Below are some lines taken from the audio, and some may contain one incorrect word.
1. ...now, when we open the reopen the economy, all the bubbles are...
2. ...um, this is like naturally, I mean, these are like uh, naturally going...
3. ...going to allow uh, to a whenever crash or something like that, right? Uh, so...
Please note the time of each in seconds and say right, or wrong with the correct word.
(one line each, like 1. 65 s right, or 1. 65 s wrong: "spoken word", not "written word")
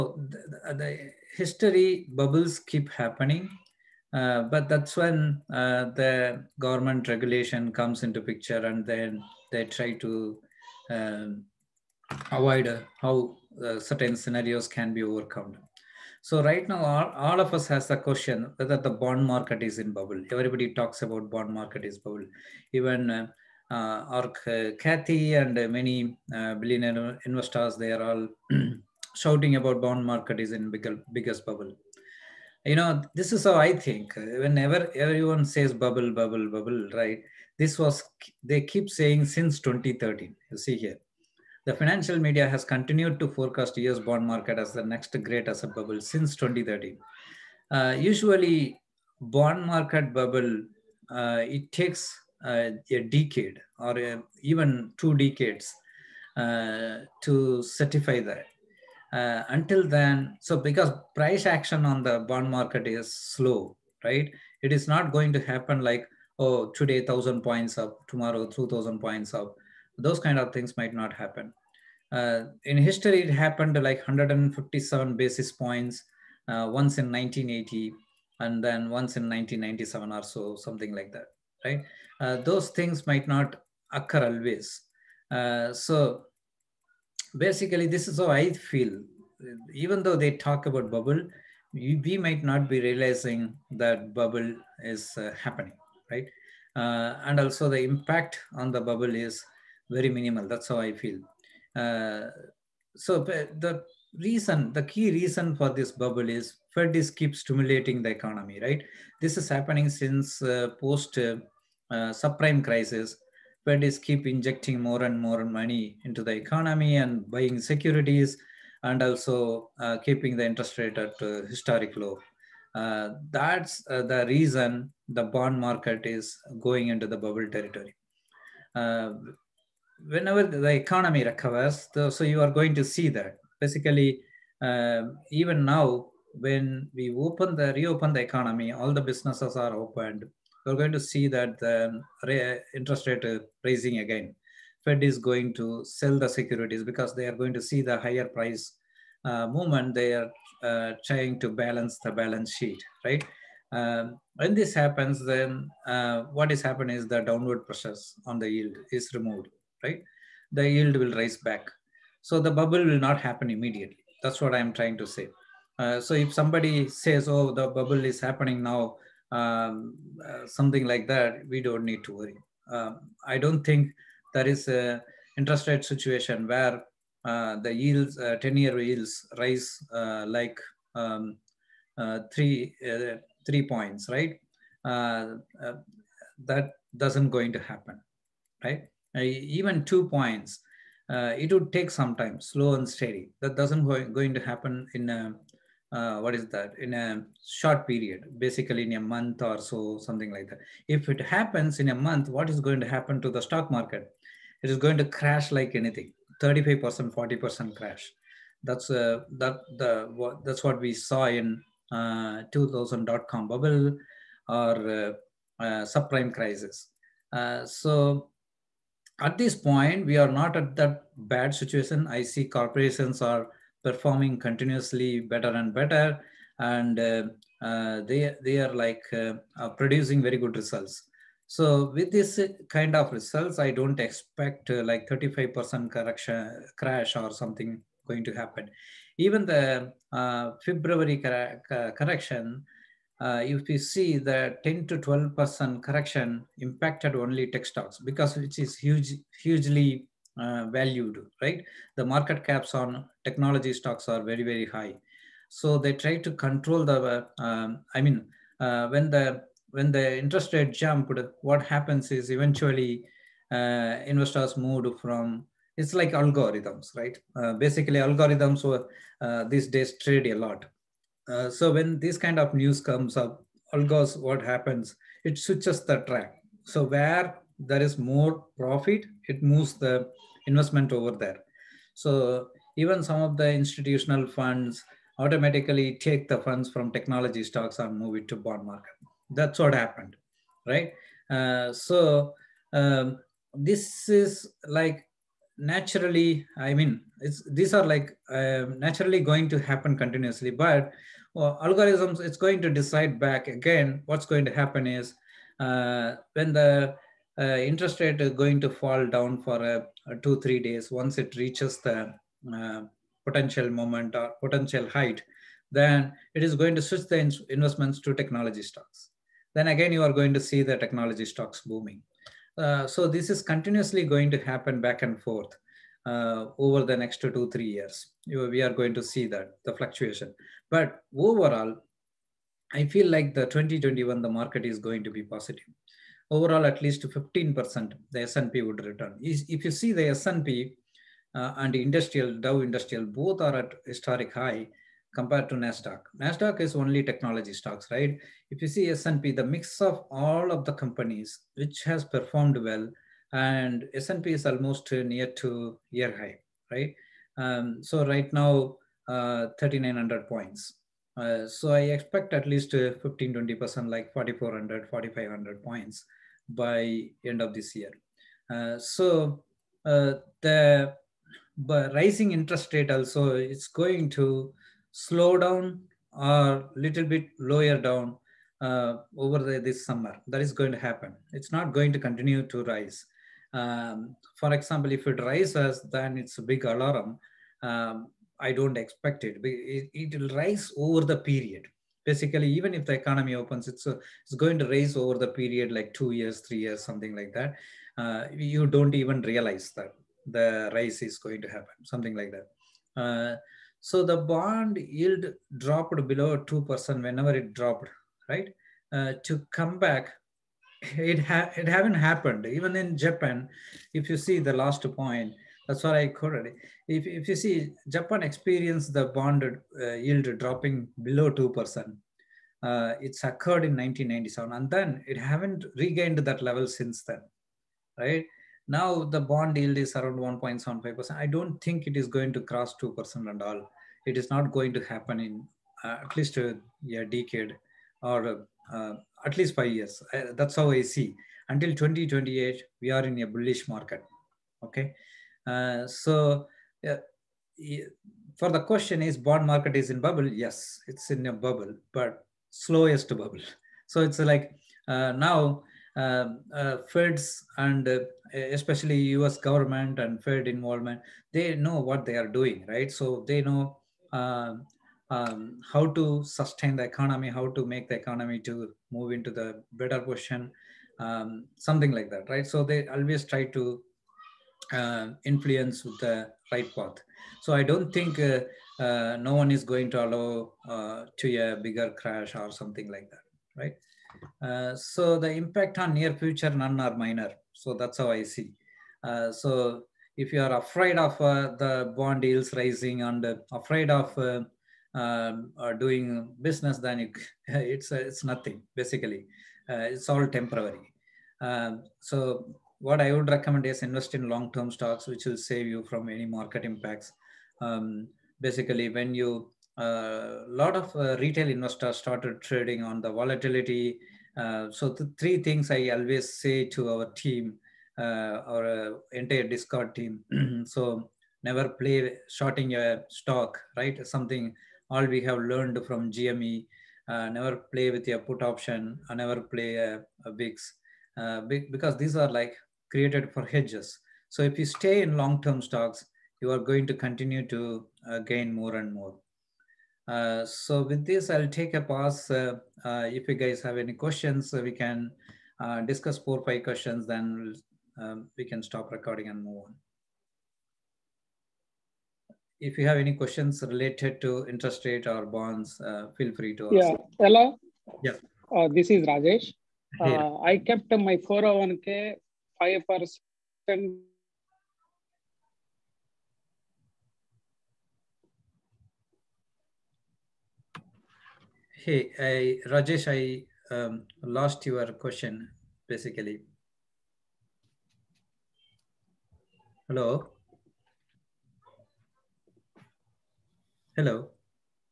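1. 135 s wrong: "businesses", not "bubbles"
2. 292 s right
3. 479 s wrong: "bigger", not "whenever".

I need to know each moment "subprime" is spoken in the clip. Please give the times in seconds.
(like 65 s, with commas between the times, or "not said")
112 s, 215 s.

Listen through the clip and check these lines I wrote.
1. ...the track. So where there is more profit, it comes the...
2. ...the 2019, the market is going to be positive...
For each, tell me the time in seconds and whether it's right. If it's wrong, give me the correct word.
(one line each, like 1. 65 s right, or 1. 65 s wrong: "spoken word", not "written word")
1. 275 s wrong: "moves", not "comes"
2. 333 s wrong: "2021", not "2019".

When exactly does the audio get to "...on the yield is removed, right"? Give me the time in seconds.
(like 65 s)
158 s.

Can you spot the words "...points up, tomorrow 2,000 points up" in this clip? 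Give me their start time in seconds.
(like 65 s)
67 s.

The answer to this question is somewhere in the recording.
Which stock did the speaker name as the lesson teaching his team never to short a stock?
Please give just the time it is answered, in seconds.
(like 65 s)
526 s.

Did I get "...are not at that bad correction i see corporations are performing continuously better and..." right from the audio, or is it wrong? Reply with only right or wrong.
wrong.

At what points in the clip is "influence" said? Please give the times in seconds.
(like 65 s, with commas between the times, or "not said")
475 s.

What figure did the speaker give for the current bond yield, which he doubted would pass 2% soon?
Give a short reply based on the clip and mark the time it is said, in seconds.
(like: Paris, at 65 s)
1.75%, at 430 s.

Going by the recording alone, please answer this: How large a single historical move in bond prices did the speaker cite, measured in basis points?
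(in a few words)
157 basis points.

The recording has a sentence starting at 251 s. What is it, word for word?
The market caps on technology stocks are very, very high.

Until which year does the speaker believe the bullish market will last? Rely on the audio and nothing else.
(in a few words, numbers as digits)
2028.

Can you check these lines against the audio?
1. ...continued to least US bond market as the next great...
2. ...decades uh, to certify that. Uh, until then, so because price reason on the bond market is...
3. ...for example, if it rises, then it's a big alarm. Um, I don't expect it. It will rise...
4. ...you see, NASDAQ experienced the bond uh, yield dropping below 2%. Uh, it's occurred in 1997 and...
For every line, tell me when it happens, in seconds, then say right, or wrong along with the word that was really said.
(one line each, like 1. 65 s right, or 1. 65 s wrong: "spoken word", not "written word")
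1. 42 s wrong: "forecast", not "least"
2. 55 s wrong: "action", not "reason"
3. 384 s right
4. 417 s wrong: "Japan", not "NASDAQ".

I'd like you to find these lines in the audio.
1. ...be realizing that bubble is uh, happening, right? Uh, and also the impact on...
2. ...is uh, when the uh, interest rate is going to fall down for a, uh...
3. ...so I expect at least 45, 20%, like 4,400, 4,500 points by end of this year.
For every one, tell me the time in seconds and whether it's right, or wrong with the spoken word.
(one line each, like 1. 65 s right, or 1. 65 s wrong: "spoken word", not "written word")
1. 92 s right
2. 304 s right
3. 361 s wrong: "15", not "45".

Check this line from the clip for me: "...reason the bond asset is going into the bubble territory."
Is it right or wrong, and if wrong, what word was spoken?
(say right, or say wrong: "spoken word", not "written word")
wrong: "market", not "asset".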